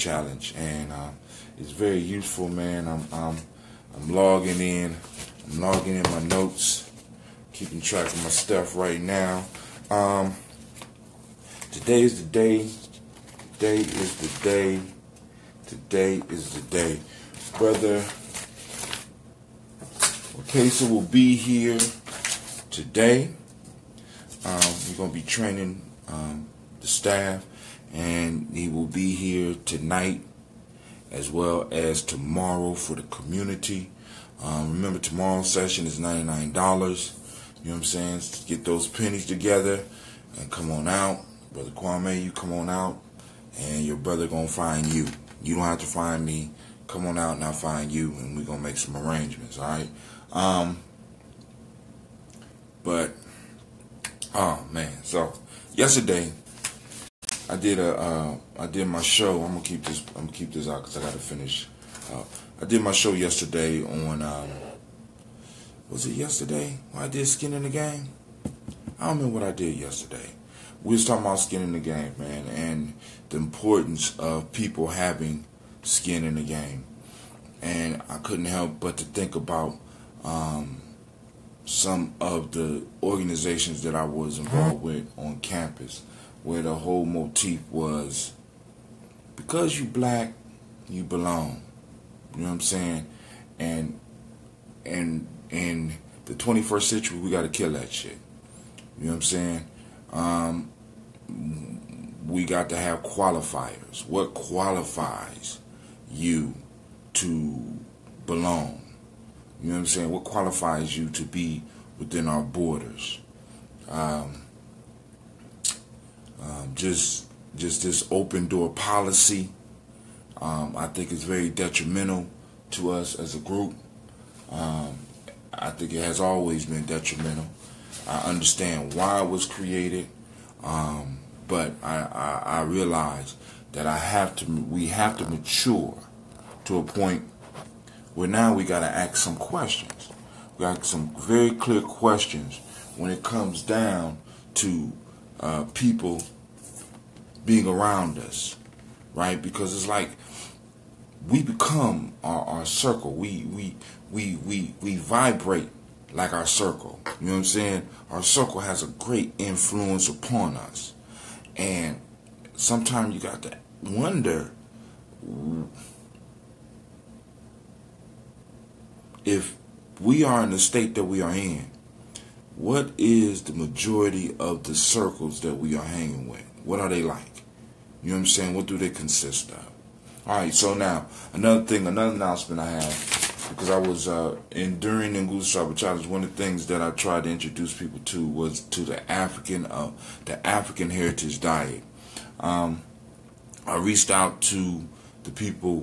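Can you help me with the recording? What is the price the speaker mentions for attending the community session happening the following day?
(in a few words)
$99.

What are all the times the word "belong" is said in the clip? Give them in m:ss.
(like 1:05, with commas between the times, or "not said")
1:31, 1:48.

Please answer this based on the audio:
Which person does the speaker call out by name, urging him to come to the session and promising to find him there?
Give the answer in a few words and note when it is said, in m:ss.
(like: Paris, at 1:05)
Brother Kwame, at 0:41.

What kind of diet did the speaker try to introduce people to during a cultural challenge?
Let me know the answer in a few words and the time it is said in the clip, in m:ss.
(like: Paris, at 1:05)
African heritage diet, at 3:10.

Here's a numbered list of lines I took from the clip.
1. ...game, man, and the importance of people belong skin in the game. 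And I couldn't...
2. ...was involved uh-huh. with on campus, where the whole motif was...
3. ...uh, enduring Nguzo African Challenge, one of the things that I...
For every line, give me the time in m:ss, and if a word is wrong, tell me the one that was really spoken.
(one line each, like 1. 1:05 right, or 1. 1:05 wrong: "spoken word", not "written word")
1. 1:11 wrong: "having", not "belong"
2. 1:24 right
3. 3:04 wrong: "Saba", not "African".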